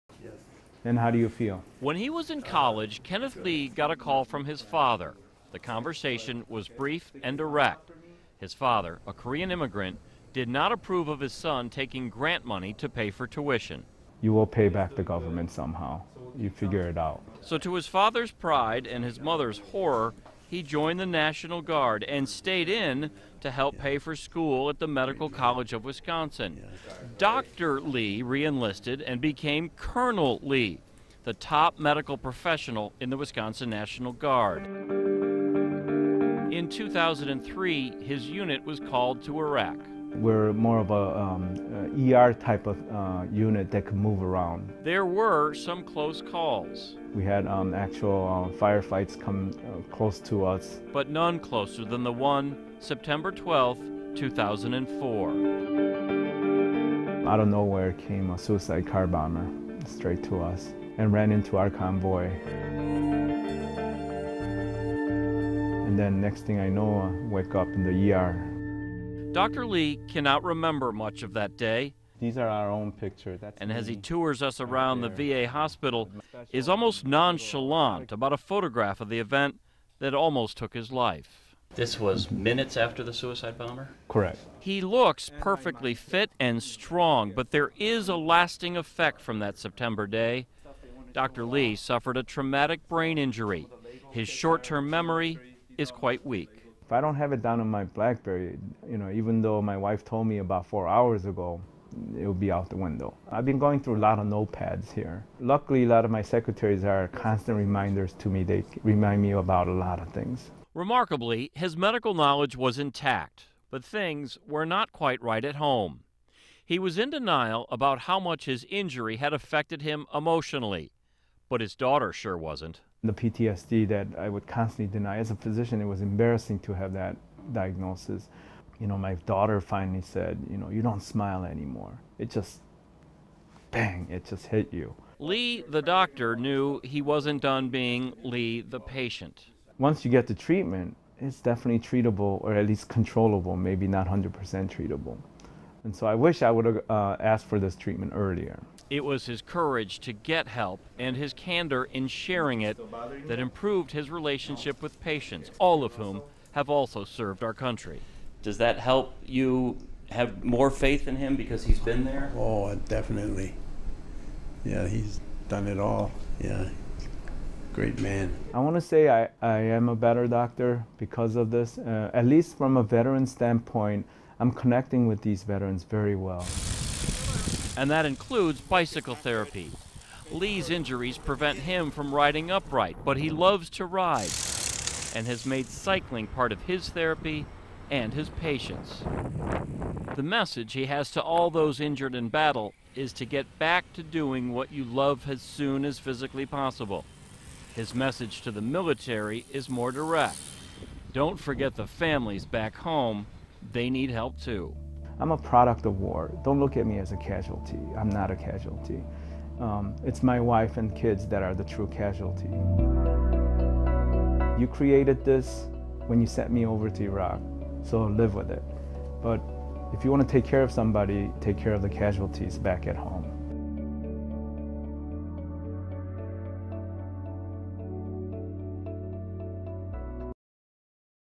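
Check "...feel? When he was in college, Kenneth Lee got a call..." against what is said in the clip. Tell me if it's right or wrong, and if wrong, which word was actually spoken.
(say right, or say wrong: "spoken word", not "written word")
right.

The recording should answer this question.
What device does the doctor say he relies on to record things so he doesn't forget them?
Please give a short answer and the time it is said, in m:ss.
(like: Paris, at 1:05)
BlackBerry, at 1:37.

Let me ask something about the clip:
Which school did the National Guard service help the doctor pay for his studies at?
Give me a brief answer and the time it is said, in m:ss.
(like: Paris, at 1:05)
Medical College of Wisconsin, at 0:24.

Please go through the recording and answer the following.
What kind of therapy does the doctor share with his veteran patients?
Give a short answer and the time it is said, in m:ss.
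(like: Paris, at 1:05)
bicycle therapy, at 2:58.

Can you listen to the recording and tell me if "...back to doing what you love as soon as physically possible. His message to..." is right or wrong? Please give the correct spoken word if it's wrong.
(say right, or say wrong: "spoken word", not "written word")
right.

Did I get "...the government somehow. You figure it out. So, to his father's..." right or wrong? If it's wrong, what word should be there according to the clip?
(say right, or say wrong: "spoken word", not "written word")
right.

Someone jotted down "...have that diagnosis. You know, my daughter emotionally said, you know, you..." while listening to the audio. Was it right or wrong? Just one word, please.
wrong.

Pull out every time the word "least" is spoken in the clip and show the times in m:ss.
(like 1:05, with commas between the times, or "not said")
2:22, 2:52.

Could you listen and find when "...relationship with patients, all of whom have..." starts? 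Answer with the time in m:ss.
2:34.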